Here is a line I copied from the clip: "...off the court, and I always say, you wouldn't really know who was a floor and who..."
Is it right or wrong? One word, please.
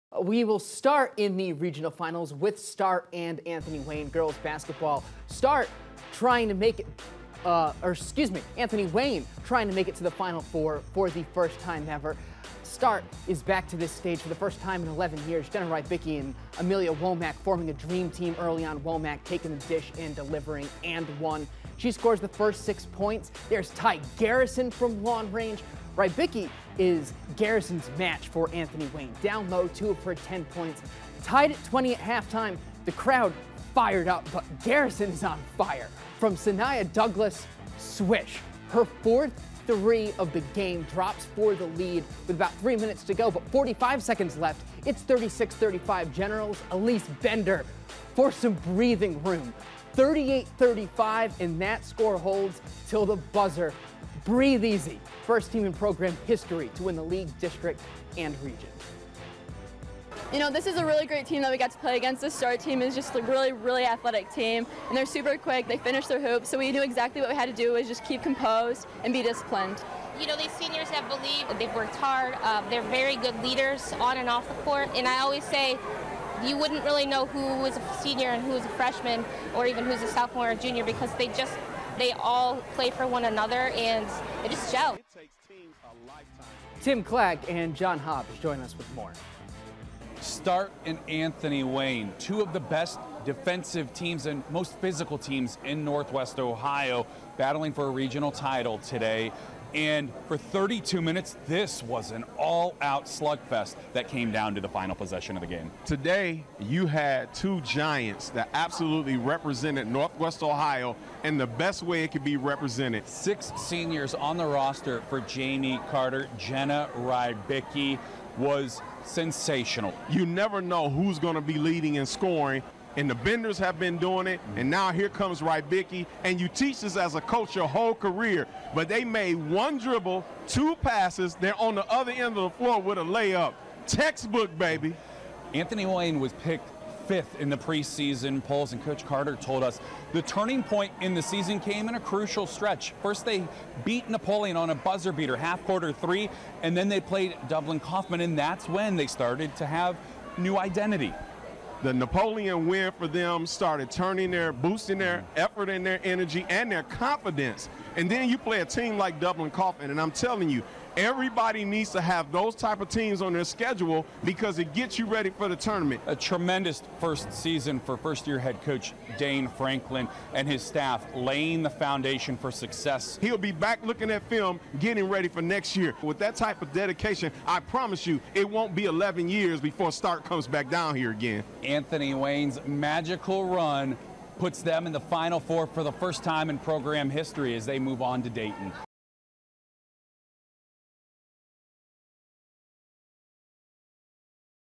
wrong.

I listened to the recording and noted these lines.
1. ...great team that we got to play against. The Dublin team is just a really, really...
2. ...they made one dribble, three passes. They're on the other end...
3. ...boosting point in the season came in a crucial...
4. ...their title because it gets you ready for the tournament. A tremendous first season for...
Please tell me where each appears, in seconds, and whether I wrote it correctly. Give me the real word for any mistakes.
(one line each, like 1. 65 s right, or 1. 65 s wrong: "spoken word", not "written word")
1. 61 s wrong: "Star", not "Dublin"
2. 128 s wrong: "two", not "three"
3. 140 s wrong: "turning", not "boosting"
4. 163 s wrong: "schedule", not "title".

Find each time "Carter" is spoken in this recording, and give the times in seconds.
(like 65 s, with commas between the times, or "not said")
115 s, 139 s.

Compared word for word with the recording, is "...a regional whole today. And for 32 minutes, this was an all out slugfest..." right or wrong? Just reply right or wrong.
wrong.